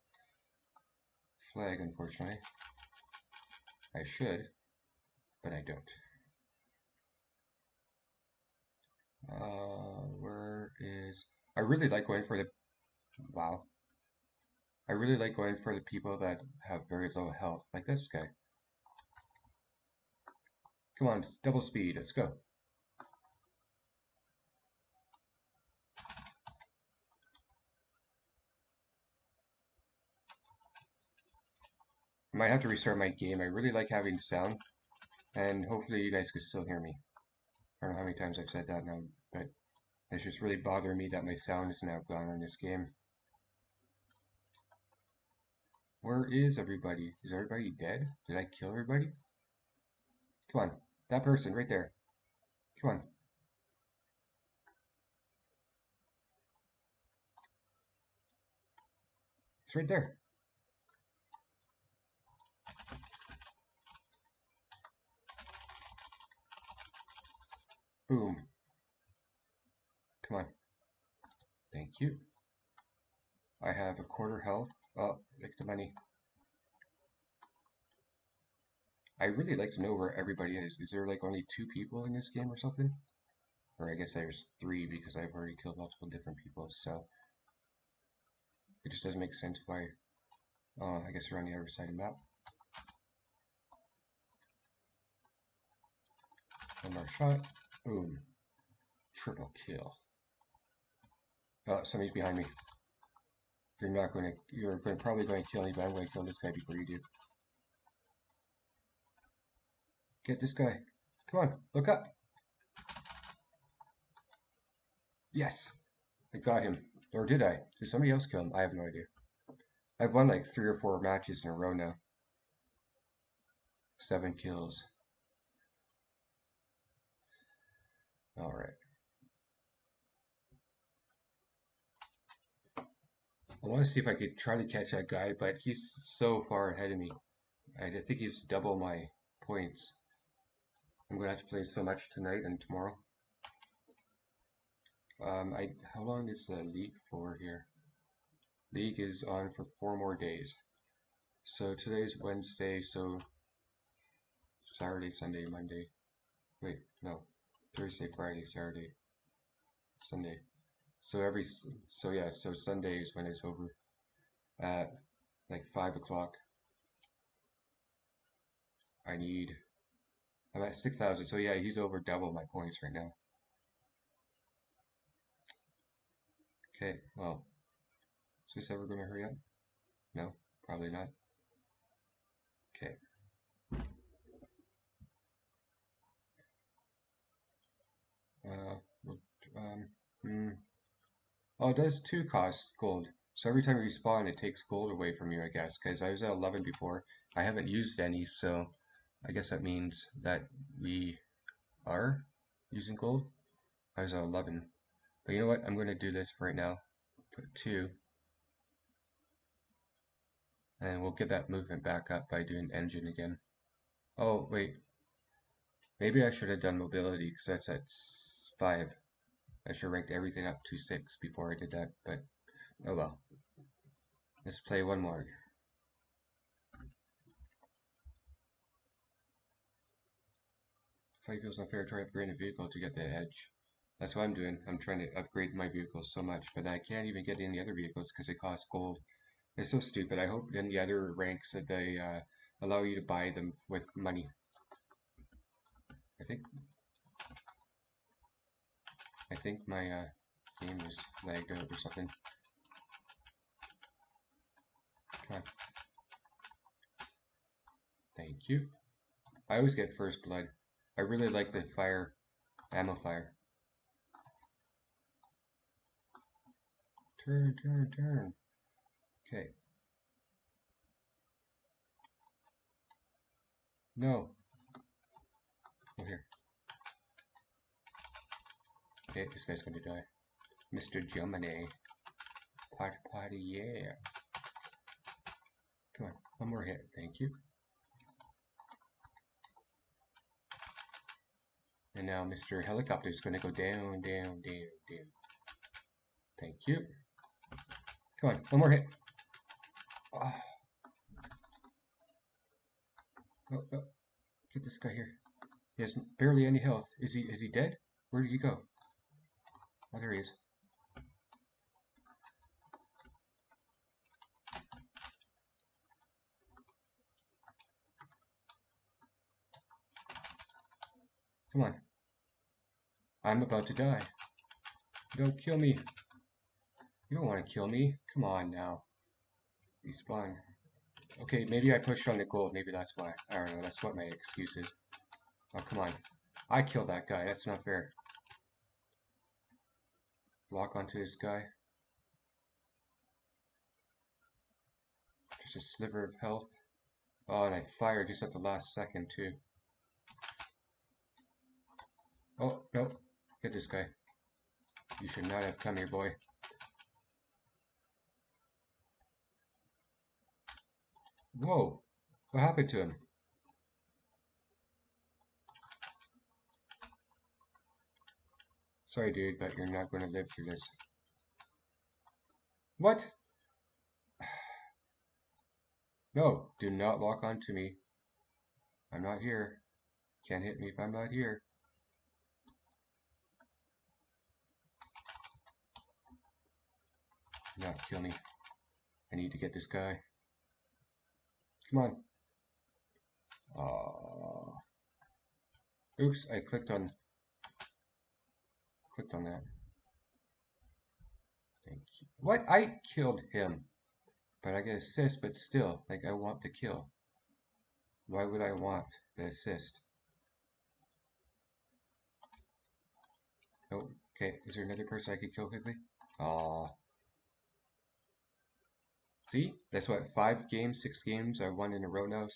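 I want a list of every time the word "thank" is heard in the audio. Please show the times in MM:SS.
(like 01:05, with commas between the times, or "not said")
01:11, 04:18, 04:46, 04:56, 06:41.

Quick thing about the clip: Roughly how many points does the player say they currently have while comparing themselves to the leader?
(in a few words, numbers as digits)
6000.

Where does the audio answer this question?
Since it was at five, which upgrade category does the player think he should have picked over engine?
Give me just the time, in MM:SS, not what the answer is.
03:36.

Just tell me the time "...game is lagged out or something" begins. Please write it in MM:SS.
04:10.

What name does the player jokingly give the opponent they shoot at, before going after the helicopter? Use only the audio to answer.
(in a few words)
Mr. Gemini.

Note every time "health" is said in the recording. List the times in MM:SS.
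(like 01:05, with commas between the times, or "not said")
00:17, 01:14, 05:06, 05:46.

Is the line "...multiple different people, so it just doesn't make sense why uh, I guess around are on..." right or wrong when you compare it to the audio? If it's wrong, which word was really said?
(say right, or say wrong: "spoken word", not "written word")
right.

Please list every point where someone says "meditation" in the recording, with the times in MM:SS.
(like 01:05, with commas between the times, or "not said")
not said.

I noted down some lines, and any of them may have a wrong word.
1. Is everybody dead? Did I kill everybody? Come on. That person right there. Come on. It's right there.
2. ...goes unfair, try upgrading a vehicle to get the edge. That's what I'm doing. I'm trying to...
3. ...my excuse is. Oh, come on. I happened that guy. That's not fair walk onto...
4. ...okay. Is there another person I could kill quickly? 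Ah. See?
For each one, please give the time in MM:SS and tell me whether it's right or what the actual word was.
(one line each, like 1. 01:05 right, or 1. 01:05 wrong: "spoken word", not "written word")
1. 00:47 right
2. 03:51 right
3. 05:33 wrong: "killed", not "happened"
4. 06:54 right.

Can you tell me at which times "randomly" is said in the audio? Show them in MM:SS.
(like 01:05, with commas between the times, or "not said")
not said.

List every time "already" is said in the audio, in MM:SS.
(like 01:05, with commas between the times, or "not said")
01:25.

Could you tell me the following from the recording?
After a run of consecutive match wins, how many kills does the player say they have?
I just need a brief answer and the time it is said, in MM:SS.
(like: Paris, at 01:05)
7, at 02:03.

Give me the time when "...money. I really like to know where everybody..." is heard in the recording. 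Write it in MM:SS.
01:15.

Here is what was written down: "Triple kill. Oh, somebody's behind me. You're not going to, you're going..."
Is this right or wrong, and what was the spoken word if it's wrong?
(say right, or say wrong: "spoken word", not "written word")
right.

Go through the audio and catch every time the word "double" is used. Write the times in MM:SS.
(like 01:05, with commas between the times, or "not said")
00:21, 02:18, 02:52.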